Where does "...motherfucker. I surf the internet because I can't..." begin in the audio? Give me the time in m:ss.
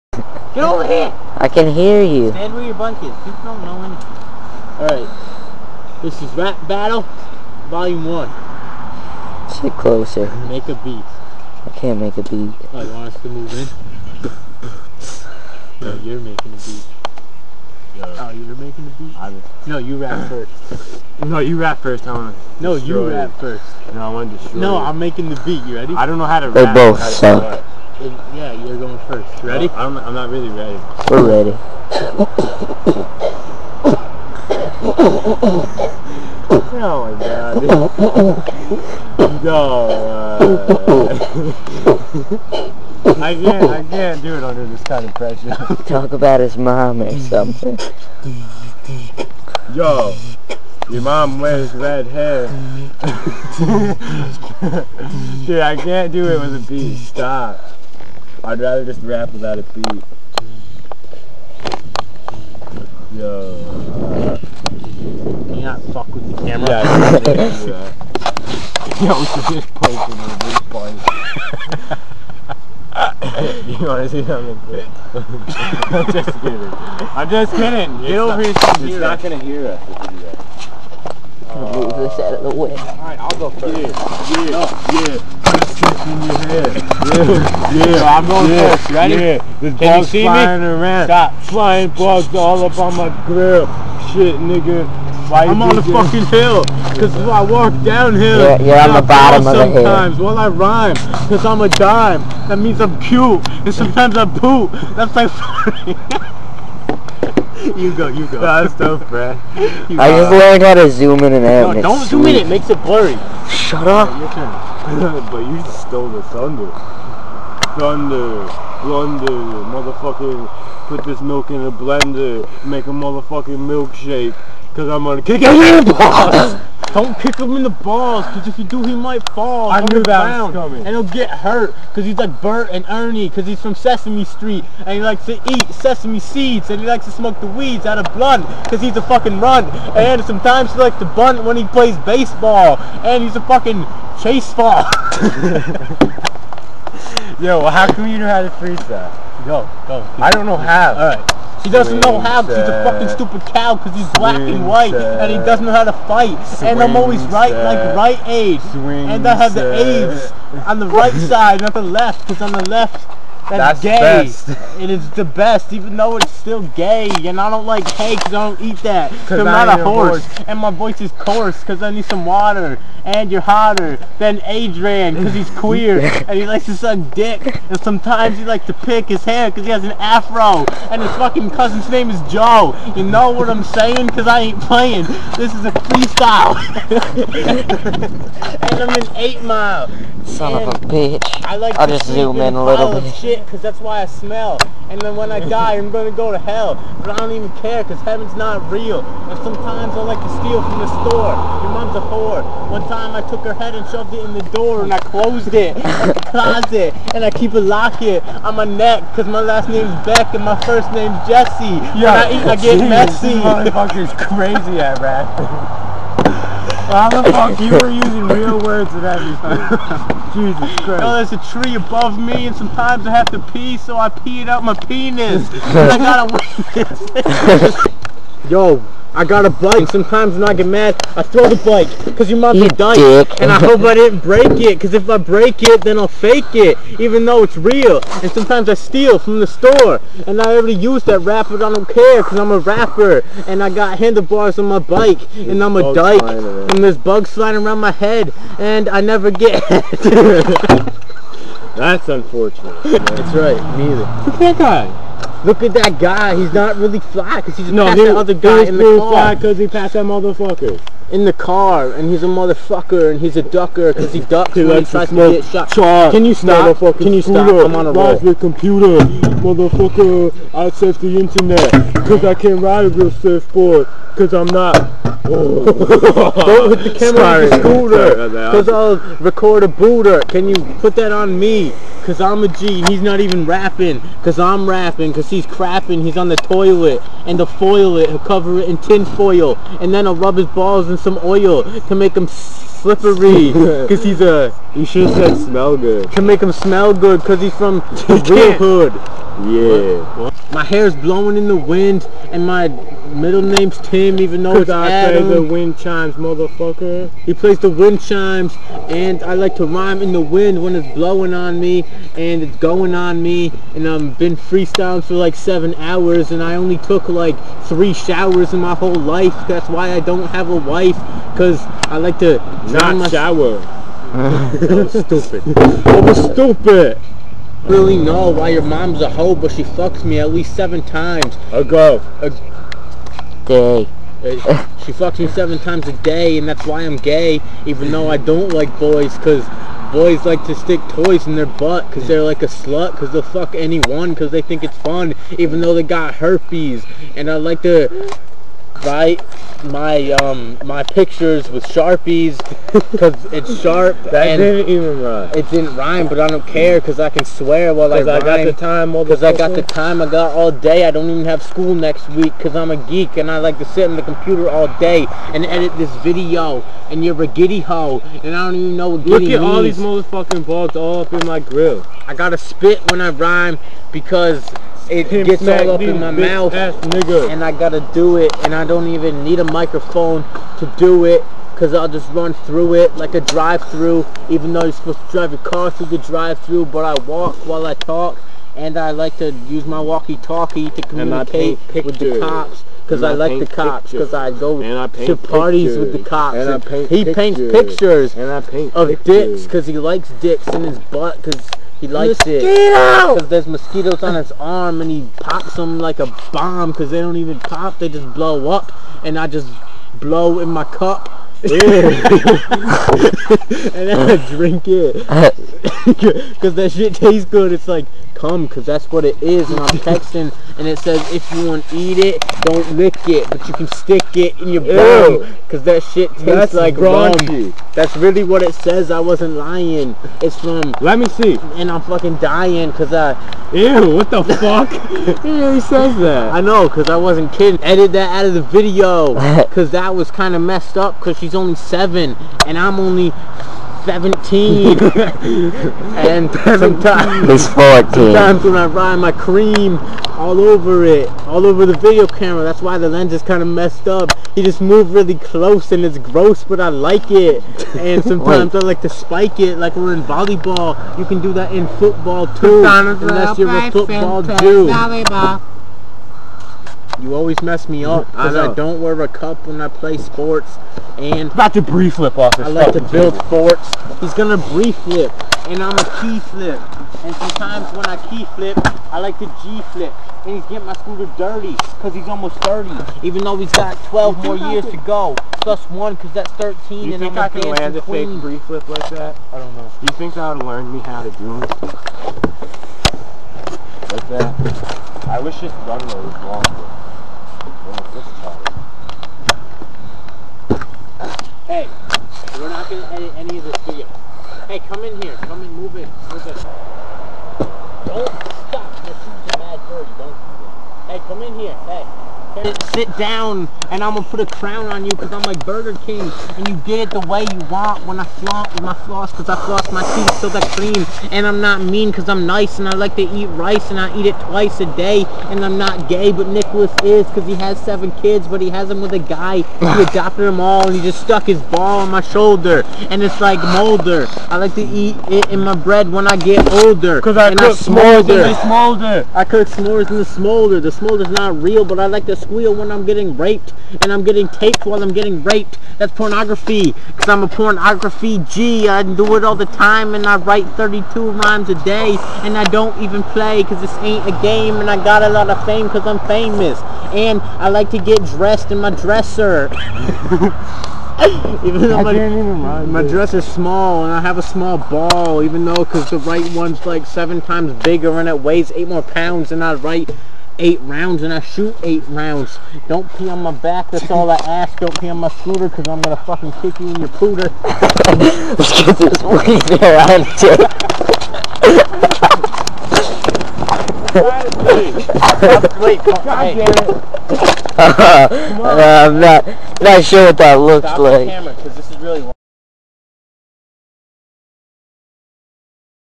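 4:29.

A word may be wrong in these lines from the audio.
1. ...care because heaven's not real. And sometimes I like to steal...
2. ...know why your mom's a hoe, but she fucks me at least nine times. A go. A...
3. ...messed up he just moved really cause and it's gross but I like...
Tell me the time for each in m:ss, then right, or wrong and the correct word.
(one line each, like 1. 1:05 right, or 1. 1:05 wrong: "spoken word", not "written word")
1. 3:17 right
2. 5:27 wrong: "seven", not "nine"
3. 7:33 wrong: "close", not "cause".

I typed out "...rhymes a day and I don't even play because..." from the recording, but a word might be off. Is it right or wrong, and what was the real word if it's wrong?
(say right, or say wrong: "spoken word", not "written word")
right.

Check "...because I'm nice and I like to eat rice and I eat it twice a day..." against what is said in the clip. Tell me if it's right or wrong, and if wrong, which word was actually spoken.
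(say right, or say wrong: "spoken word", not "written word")
right.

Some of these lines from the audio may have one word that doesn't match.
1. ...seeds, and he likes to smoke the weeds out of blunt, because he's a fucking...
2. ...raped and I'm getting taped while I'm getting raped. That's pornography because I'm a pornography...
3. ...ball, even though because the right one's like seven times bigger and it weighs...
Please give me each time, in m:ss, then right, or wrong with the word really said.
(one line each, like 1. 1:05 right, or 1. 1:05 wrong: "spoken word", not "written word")
1. 2:16 right
2. 9:03 right
3. 9:24 right.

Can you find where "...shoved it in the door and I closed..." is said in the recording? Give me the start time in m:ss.
3:23.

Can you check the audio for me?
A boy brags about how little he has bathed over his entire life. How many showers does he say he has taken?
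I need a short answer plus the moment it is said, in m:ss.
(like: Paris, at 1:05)
3, at 5:17.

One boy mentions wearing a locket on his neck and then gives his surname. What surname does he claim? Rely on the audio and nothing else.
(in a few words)
Beck.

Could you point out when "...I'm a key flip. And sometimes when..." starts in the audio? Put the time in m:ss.
7:55.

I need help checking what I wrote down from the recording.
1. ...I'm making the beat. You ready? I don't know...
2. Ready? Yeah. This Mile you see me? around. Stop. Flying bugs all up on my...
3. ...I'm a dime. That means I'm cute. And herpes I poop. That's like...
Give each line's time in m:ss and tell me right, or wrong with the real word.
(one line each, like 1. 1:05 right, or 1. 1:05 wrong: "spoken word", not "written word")
1. 0:24 right
2. 1:28 wrong: "Can", not "Mile"
3. 1:41 wrong: "sometimes", not "herpes".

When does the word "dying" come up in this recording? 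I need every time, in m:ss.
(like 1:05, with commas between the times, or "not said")
3:52, 7:12.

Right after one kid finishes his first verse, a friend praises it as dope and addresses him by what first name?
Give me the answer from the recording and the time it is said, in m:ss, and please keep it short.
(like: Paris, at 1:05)
Brad, at 1:49.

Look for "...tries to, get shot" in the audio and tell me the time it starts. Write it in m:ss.
4:24.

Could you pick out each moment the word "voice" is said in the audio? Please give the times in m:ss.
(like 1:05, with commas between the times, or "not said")
2:50.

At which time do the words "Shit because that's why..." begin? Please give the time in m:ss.
3:13.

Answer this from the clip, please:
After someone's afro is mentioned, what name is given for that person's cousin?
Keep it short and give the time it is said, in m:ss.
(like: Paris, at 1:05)
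Joe, at 3:02.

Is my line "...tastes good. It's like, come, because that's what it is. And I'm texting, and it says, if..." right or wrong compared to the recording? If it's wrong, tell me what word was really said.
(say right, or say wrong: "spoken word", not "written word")
right.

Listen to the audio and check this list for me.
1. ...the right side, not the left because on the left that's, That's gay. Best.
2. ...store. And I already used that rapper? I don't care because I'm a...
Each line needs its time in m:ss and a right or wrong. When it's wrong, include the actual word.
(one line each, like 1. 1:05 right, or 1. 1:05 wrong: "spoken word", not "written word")
1. 2:40 right
2. 3:59 right.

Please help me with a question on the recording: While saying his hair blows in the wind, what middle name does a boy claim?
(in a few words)
Tim.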